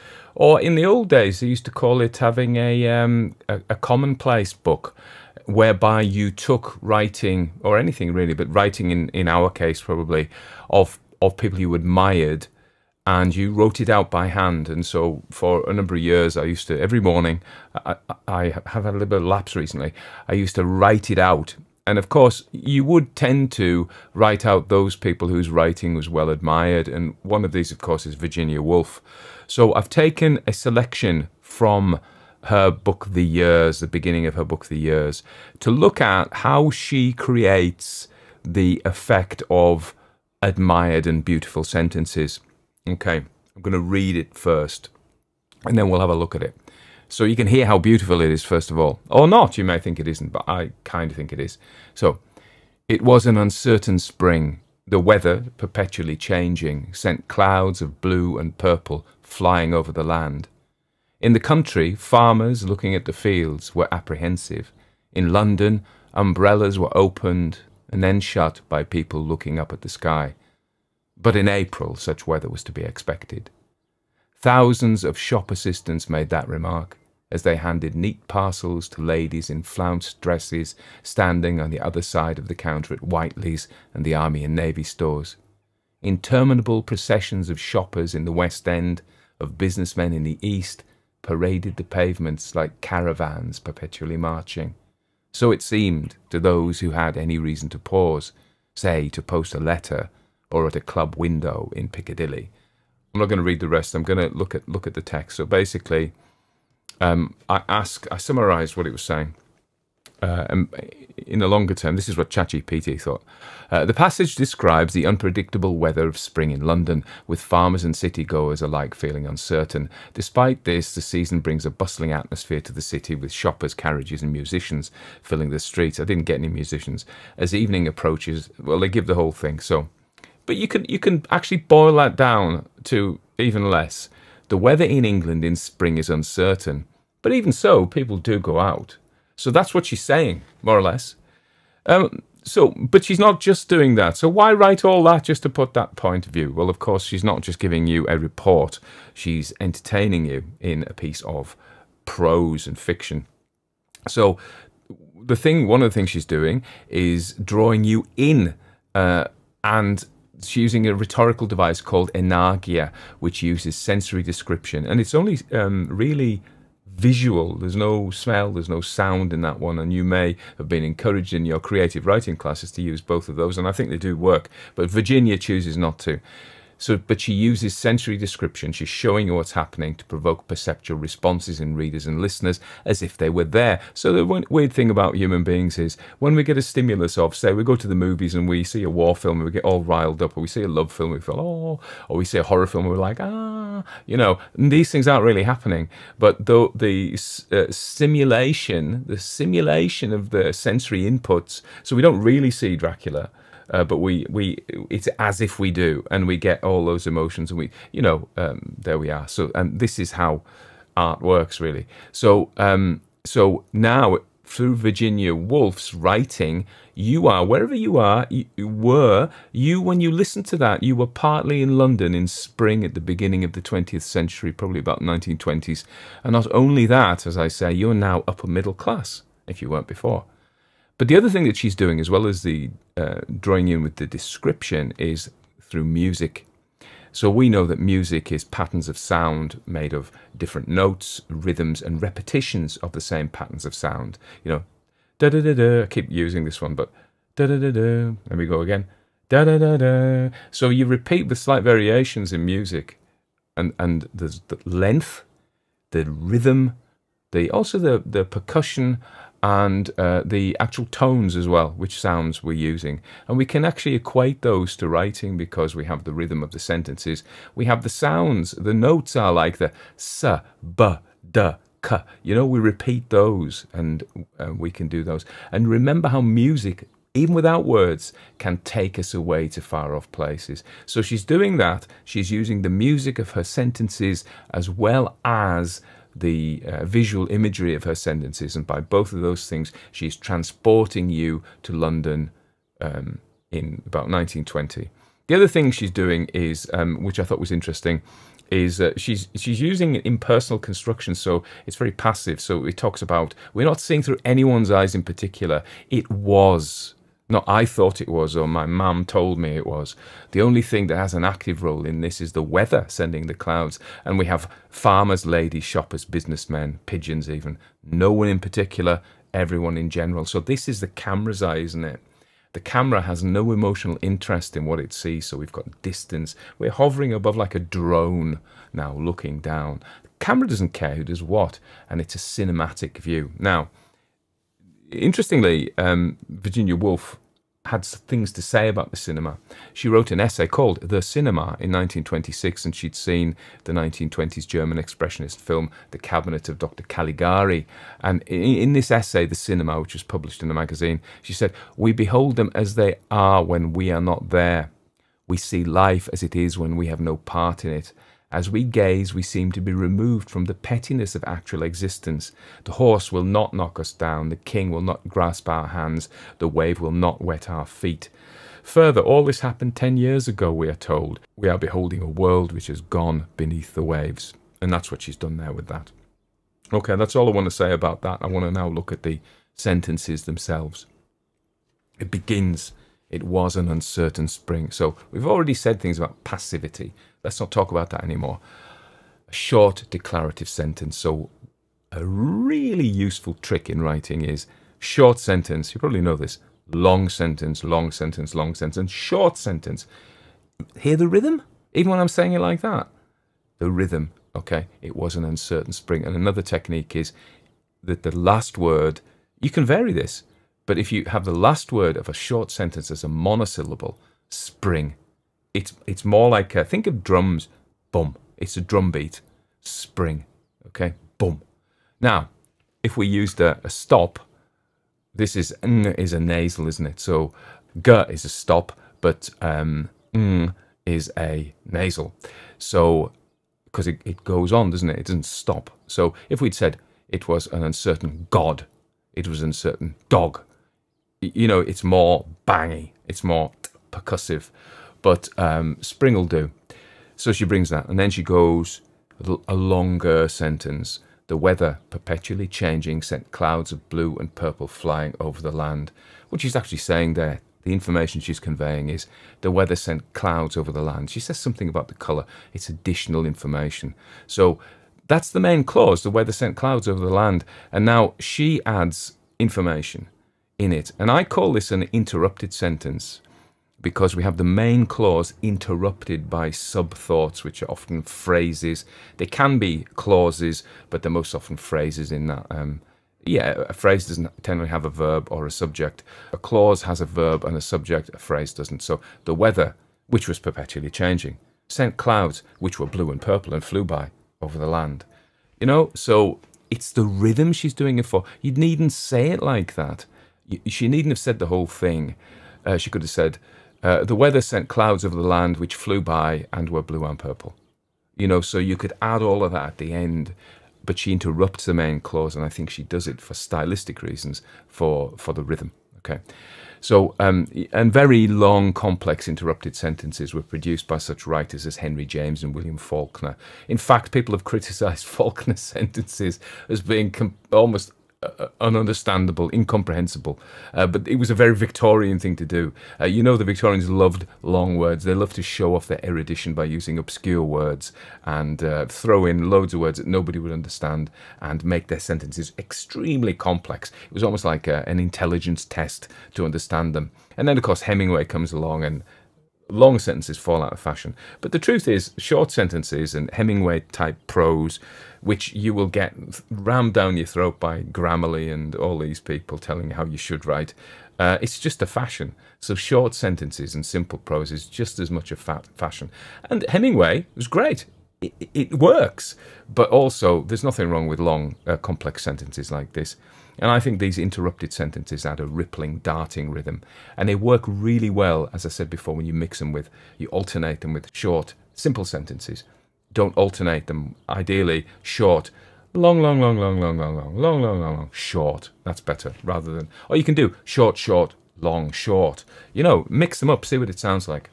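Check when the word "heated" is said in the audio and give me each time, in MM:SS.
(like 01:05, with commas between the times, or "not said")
not said.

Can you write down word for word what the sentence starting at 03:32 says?
So um, so now through Virginia Woolf's writing, you are wherever you are.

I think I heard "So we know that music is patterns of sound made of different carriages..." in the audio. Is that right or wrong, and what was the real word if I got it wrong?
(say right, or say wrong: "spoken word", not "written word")
wrong: "notes", not "carriages".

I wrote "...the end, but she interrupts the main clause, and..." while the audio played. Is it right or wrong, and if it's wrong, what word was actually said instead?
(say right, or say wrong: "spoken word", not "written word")
right.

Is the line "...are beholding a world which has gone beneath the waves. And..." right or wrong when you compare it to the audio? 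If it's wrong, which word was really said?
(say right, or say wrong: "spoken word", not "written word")
right.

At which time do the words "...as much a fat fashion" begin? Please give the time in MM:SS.
09:24.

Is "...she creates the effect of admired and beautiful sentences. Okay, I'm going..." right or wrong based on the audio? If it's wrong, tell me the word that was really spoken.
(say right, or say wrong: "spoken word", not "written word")
right.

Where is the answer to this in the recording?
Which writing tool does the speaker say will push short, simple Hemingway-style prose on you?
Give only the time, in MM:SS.
09:17.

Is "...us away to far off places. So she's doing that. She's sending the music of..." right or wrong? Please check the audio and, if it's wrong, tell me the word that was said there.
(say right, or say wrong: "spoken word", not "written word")
wrong: "using", not "sending".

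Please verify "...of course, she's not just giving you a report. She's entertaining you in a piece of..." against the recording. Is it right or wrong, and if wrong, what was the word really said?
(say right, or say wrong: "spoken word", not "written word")
right.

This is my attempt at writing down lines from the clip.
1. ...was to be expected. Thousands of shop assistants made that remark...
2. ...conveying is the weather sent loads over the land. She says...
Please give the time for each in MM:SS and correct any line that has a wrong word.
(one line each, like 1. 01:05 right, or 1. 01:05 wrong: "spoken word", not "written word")
1. 01:12 right
2. 07:38 wrong: "clouds", not "loads".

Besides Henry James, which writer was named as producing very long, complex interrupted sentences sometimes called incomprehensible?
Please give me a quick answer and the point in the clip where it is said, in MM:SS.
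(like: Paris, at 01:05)
William Faulkner, at 08:42.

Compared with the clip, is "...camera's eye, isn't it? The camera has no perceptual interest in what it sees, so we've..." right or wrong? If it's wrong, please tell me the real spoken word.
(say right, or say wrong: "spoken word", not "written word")
wrong: "emotional", not "perceptual".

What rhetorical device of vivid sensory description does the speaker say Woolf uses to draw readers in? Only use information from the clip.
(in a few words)
enargia.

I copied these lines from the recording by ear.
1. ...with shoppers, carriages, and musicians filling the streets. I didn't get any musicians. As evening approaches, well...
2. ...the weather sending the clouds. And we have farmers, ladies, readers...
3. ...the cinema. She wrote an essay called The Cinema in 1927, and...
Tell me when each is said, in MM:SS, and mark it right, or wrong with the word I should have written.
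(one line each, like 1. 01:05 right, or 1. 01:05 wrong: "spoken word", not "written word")
1. 02:03 right
2. 05:12 wrong: "shoppers", not "readers"
3. 05:38 wrong: "1926", not "1927".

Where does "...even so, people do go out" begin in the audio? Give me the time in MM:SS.
02:17.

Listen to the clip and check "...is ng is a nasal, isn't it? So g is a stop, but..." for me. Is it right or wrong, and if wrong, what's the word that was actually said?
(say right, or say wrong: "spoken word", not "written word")
right.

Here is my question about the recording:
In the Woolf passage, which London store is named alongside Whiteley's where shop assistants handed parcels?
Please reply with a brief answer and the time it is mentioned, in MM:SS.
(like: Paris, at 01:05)
Army and Navy stores, at 01:24.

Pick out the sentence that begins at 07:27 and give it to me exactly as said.
So she brings that, and then she goes a longer sentence.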